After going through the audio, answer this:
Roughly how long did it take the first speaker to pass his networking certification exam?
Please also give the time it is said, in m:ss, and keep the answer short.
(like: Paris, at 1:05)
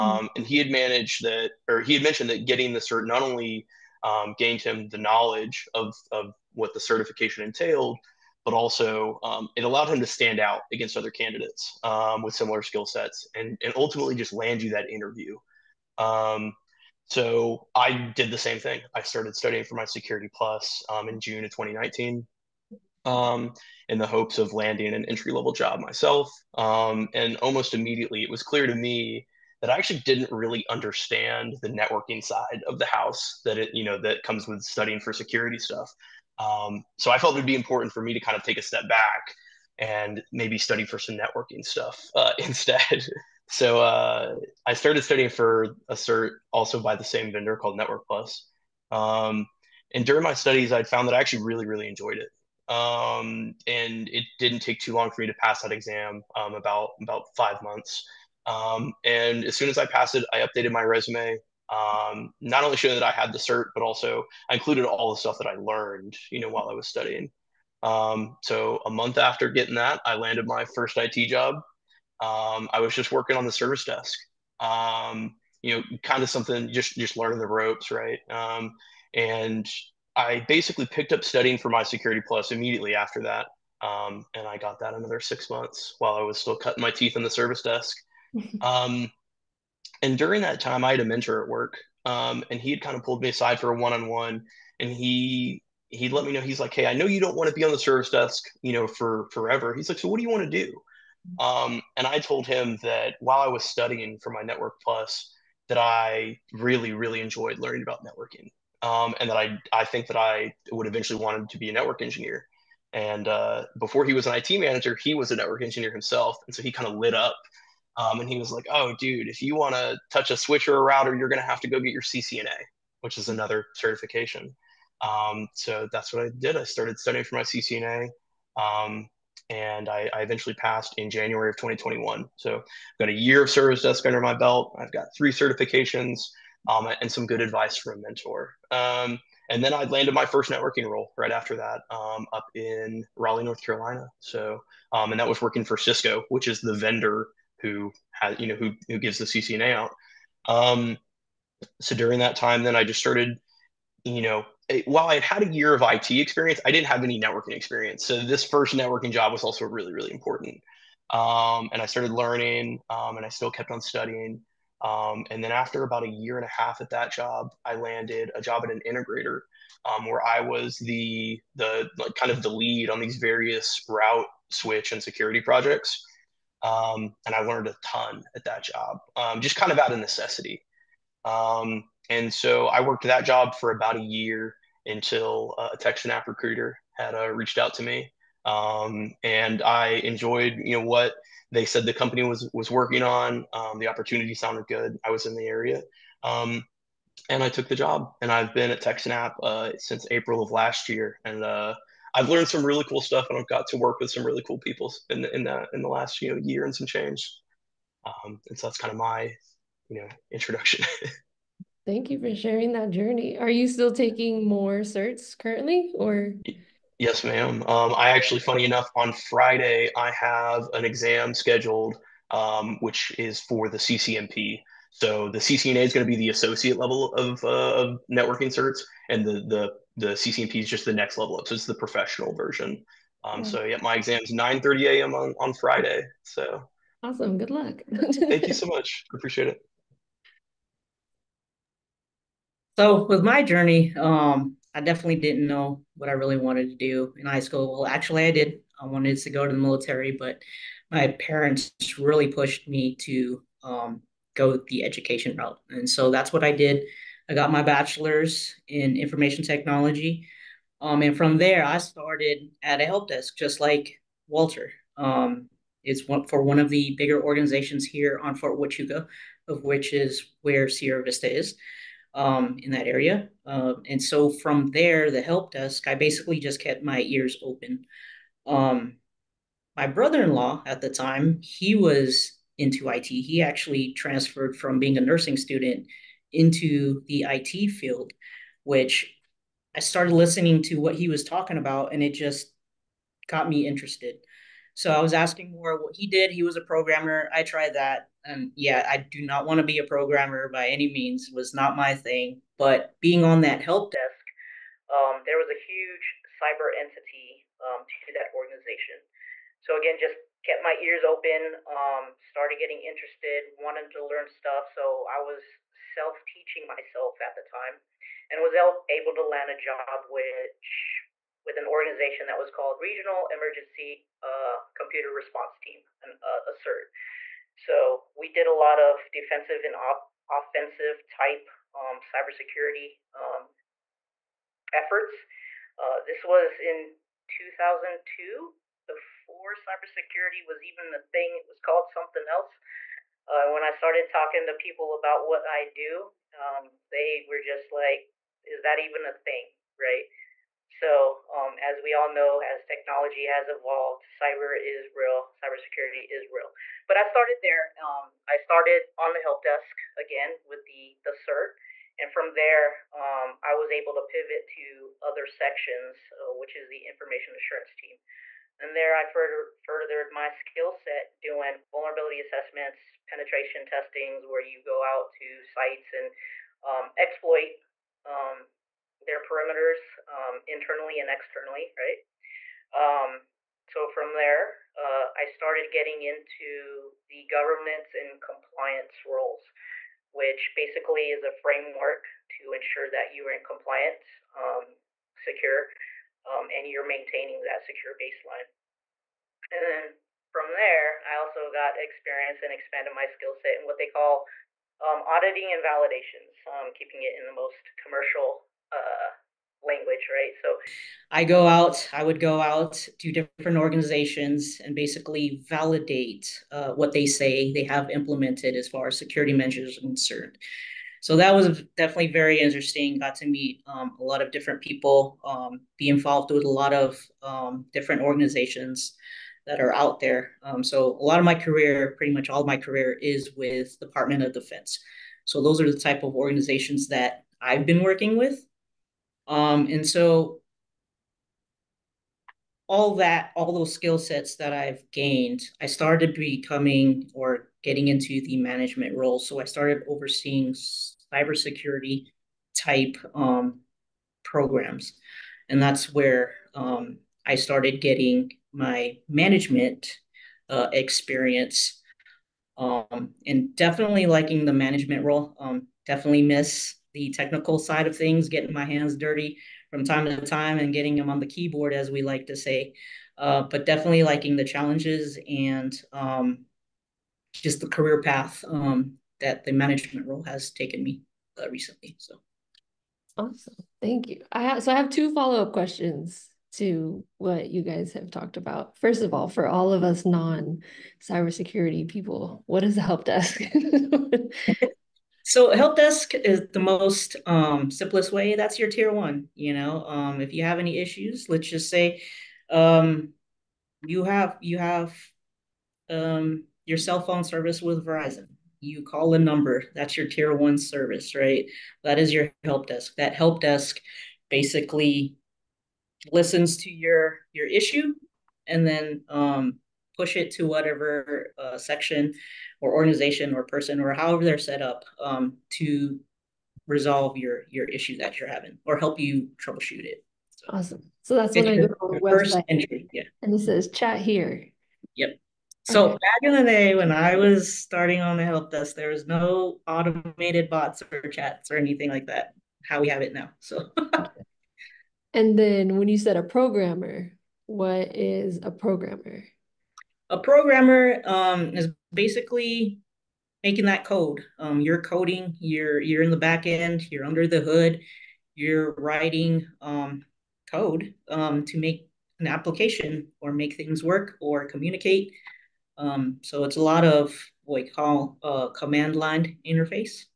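5 months, at 0:57.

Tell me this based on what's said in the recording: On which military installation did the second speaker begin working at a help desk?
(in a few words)
Fort Huachuca.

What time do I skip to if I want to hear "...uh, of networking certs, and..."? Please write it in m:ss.
3:47.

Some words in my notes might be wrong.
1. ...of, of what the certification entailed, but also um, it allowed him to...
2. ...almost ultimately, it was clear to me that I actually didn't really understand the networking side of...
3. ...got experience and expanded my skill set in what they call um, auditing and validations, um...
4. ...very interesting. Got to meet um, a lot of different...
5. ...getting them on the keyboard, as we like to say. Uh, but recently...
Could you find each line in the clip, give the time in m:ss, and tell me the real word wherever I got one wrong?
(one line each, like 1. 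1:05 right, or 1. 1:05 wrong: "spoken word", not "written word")
1. 0:05 right
2. 0:27 wrong: "immediately", not "ultimately"
3. 6:41 right
4. 7:02 right
5. 7:50 wrong: "definitely", not "recently".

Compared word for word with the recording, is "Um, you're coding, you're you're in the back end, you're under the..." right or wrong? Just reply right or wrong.
right.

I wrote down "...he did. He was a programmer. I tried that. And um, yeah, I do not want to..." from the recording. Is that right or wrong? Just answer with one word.
right.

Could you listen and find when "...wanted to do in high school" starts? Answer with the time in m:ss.
4:06.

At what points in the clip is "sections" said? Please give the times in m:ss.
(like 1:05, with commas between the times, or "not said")
6:05, 8:41.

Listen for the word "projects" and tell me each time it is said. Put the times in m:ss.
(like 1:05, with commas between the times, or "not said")
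2:55.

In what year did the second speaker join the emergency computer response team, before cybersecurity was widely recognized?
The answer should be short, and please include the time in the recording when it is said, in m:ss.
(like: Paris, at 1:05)
2002, at 5:37.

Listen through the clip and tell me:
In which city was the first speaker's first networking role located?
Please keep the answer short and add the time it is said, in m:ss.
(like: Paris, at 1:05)
Raleigh, North Carolina, at 2:23.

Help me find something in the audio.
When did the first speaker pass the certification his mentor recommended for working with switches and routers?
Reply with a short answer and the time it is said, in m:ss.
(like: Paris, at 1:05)
January 2021, at 2:11.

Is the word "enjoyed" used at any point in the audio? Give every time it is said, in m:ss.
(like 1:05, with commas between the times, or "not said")
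0:51, 1:47, 3:10.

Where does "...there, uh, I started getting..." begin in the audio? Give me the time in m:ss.
6:24.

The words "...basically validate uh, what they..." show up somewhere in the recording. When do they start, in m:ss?
6:54.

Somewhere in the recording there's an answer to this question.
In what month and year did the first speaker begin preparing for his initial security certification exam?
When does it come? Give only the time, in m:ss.
0:21.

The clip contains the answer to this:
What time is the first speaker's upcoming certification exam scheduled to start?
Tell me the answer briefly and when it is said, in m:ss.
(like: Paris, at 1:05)
9:30 a.m., at 3:54.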